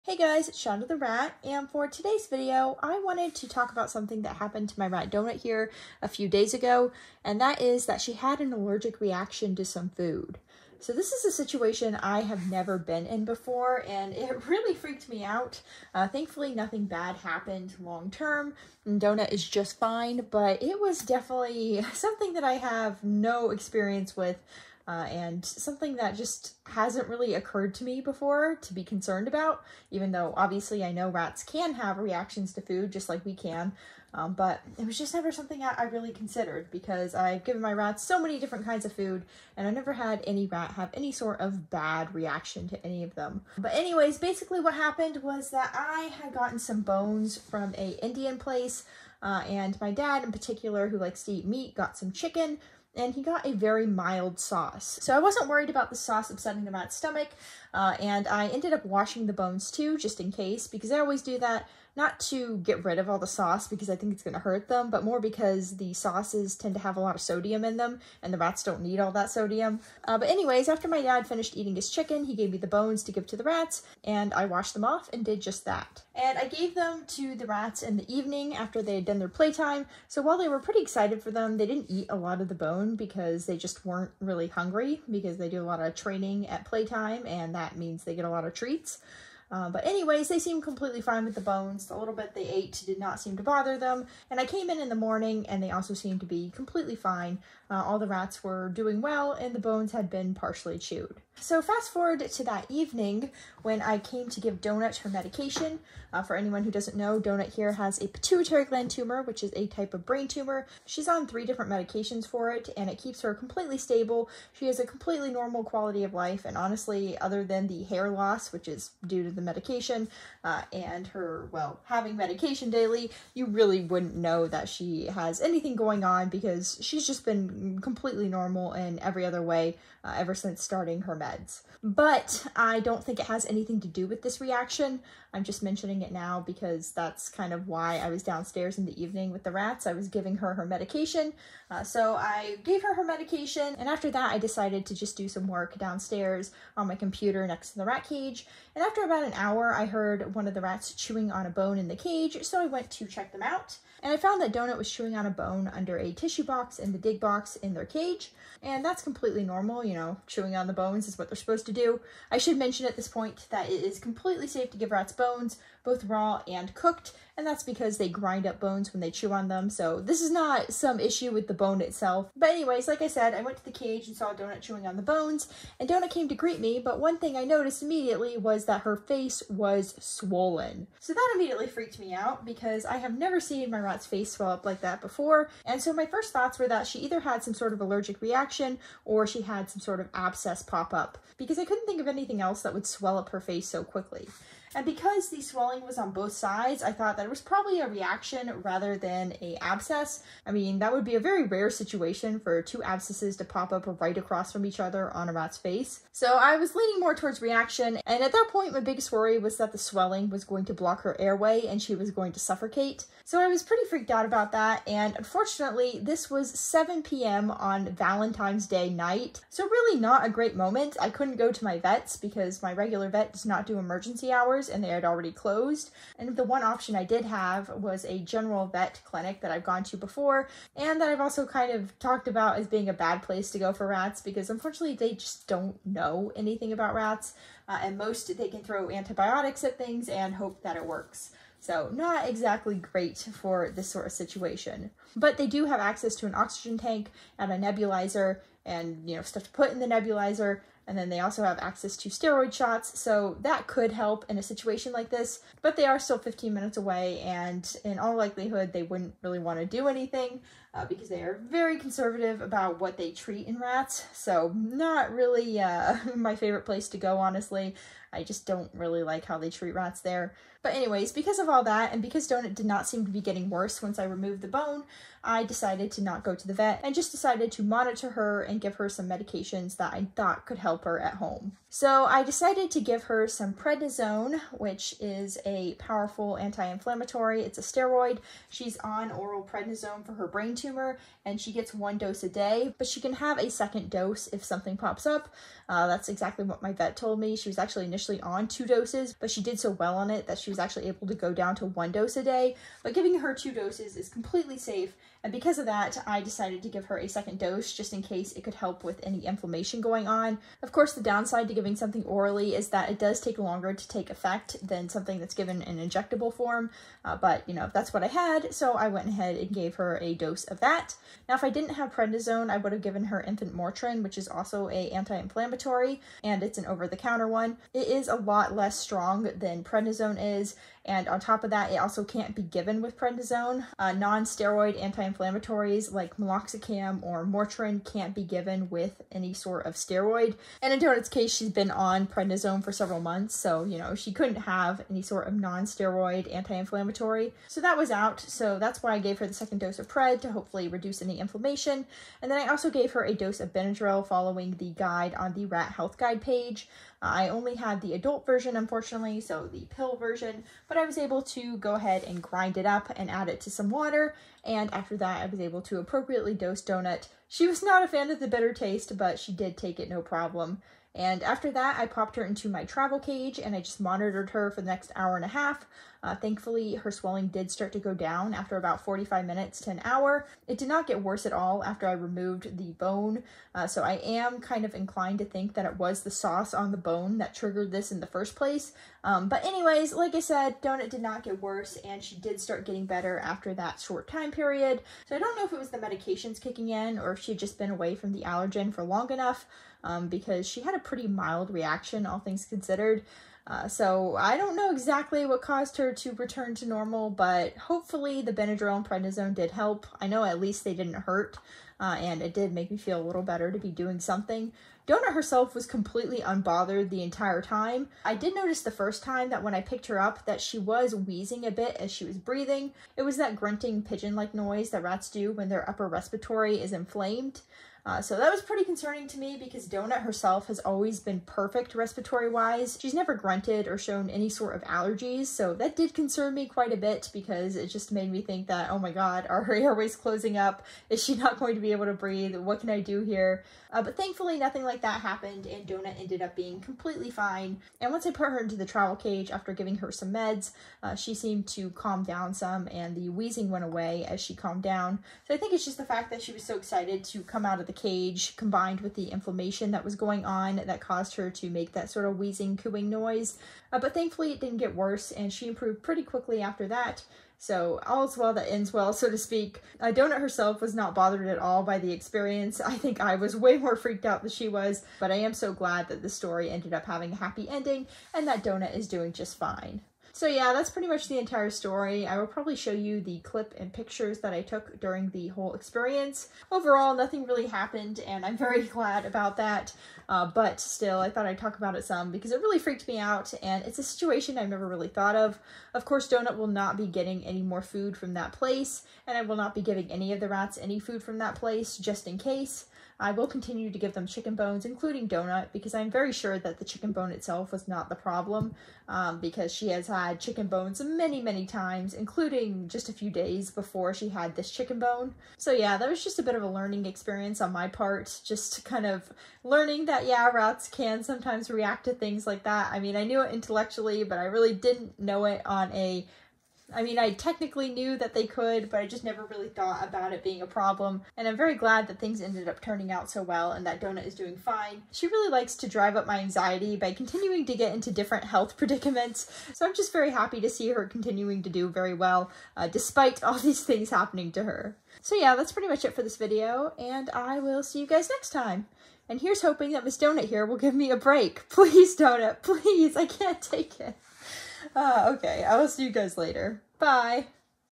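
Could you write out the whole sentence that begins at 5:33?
Uh, non-steroid anti anti-inflammatories like meloxicam or Motrin can't be given with any sort of steroid.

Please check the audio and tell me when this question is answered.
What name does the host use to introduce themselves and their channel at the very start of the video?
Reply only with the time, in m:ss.
0:00.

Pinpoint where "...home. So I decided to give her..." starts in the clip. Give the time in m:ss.
4:41.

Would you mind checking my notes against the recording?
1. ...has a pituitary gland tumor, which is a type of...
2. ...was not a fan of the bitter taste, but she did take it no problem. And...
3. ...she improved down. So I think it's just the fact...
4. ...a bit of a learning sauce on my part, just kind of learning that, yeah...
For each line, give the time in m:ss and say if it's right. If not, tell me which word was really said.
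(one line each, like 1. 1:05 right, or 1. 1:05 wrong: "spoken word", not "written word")
1. 1:47 right
2. 6:07 right
3. 7:34 wrong: "calmed", not "improved"
4. 8:36 wrong: "experience", not "sauce".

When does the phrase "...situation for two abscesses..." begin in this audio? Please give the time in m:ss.
3:21.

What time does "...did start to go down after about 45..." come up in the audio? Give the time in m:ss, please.
6:17.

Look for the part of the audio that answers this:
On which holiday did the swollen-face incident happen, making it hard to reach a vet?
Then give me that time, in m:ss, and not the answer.
3:37.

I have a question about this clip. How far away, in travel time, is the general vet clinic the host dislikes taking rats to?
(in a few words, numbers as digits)
15 minutes.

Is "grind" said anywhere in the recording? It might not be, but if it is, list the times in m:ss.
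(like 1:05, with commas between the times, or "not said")
2:48, 6:02.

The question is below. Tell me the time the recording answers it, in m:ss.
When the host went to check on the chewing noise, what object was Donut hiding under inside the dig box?
2:36.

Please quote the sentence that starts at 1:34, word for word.
And I came in in the morning and they also seemed to be completely fine.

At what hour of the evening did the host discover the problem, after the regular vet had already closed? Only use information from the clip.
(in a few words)
7 p.m.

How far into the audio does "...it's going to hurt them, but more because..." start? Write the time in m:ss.
1:04.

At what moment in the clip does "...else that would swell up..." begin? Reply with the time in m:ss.
3:12.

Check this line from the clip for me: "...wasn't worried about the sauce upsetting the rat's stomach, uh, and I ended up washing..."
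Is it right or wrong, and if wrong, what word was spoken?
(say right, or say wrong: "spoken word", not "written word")
right.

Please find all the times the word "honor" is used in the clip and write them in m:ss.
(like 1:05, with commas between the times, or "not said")
not said.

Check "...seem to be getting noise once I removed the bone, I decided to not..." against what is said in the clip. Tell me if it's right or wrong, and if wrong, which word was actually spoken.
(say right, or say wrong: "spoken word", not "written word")
wrong: "worse", not "noise".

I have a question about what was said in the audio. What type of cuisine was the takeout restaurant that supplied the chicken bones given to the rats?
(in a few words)
Indian.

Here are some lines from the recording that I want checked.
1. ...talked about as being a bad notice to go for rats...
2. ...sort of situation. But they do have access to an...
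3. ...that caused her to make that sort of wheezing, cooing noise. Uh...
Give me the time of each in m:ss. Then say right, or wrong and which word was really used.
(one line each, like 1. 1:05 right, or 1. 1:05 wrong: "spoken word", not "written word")
1. 3:51 wrong: "place", not "notice"
2. 4:03 right
3. 7:40 right.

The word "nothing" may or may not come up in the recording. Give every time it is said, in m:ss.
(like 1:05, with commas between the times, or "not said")
0:16, 7:24, 8:06.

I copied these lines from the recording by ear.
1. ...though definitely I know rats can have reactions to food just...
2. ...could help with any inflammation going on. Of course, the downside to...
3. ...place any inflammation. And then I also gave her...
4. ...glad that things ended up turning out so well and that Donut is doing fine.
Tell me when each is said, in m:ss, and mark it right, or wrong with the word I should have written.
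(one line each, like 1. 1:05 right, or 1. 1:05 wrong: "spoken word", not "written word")
1. 0:30 wrong: "obviously", not "definitely"
2. 5:08 right
3. 5:50 wrong: "reduce", not "place"
4. 8:51 right.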